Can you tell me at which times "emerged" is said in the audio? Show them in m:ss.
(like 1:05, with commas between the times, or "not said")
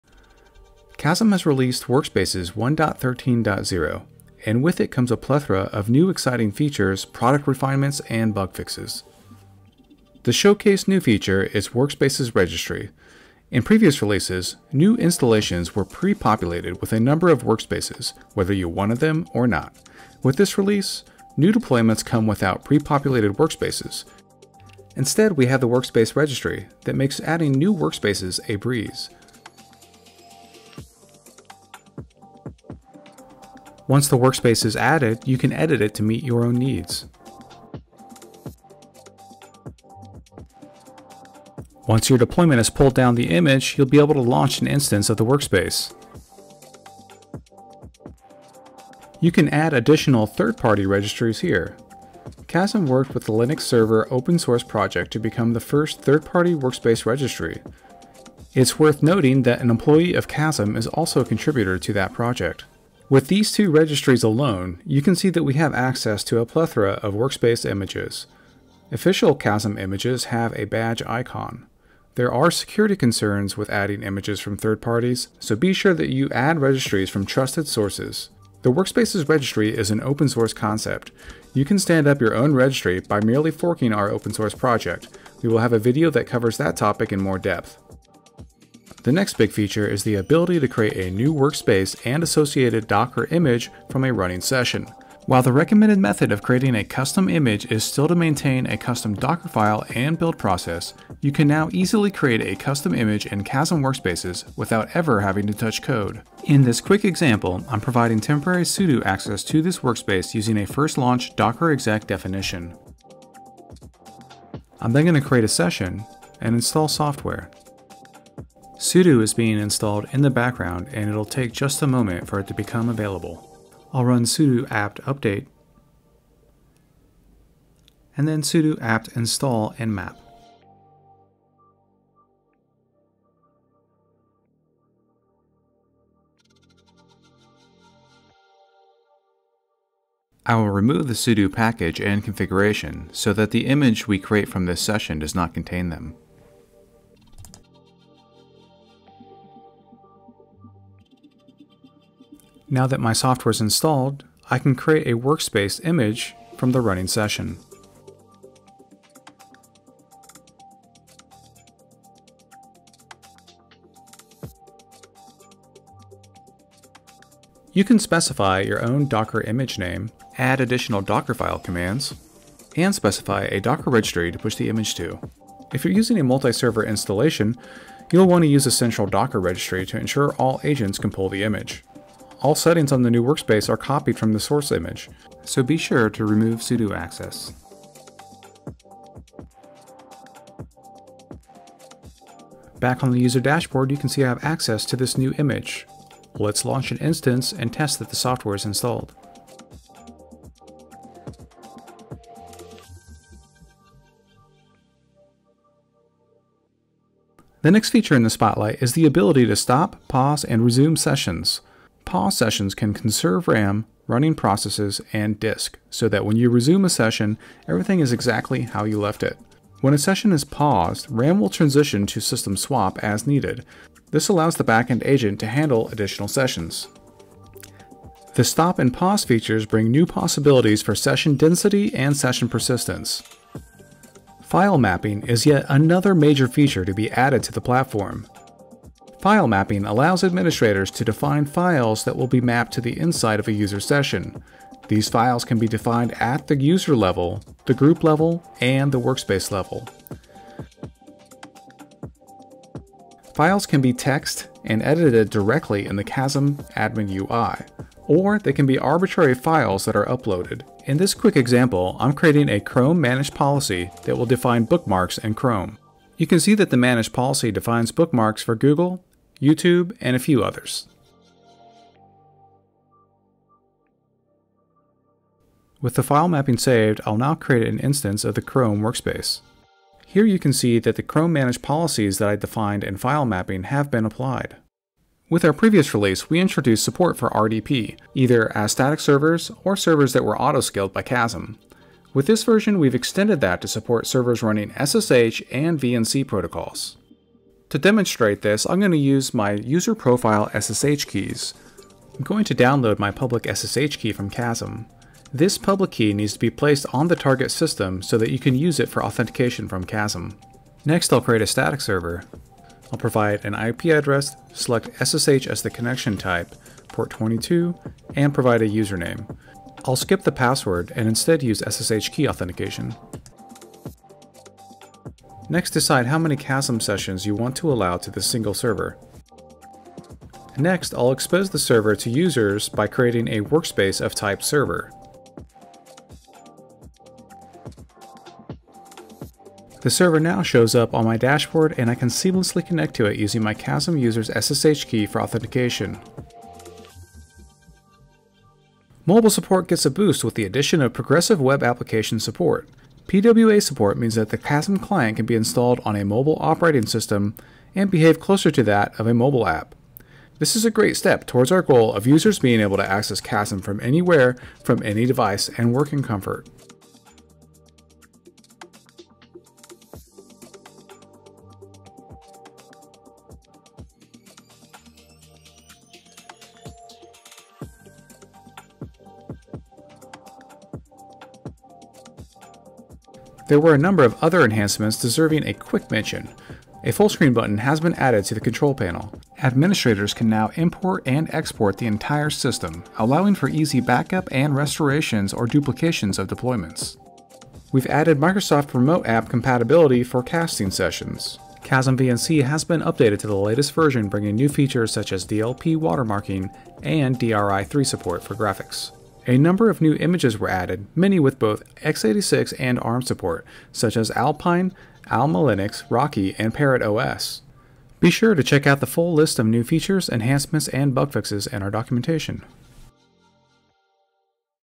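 not said.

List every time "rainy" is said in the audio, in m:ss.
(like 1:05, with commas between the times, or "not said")
not said.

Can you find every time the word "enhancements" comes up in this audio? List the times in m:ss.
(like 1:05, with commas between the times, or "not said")
6:24, 7:00.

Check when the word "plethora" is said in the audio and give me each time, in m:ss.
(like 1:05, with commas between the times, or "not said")
0:05, 1:06.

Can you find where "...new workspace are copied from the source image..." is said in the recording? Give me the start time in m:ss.
3:03.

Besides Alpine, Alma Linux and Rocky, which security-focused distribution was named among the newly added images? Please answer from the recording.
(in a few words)
Parrot OS.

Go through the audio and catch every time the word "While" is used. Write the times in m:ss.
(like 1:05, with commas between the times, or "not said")
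1:35.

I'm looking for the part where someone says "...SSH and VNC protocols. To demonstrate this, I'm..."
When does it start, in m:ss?
4:54.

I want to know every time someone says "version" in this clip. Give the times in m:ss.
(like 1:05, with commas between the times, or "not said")
4:52, 6:43.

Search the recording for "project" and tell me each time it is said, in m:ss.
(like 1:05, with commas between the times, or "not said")
0:54, 1:02, 1:24.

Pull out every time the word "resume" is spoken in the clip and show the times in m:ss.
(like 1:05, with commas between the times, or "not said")
3:30, 3:36.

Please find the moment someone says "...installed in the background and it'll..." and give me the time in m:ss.
1:59.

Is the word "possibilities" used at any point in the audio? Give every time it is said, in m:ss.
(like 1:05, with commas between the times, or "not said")
3:50.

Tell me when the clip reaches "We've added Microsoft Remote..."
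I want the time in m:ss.
6:37.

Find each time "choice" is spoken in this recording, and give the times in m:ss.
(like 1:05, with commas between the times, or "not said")
not said.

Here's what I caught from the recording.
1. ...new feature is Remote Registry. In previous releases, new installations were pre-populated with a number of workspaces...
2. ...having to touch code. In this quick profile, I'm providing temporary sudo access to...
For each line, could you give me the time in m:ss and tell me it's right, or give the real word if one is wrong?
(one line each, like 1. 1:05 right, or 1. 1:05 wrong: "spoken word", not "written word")
1. 0:10 wrong: "Workspaces", not "Remote"
2. 1:45 wrong: "example", not "profile".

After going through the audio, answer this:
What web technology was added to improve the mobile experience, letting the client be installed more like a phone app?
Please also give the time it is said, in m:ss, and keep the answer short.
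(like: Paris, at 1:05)
progressive web application, at 5:50.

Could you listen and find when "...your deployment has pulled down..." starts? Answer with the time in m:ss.
0:42.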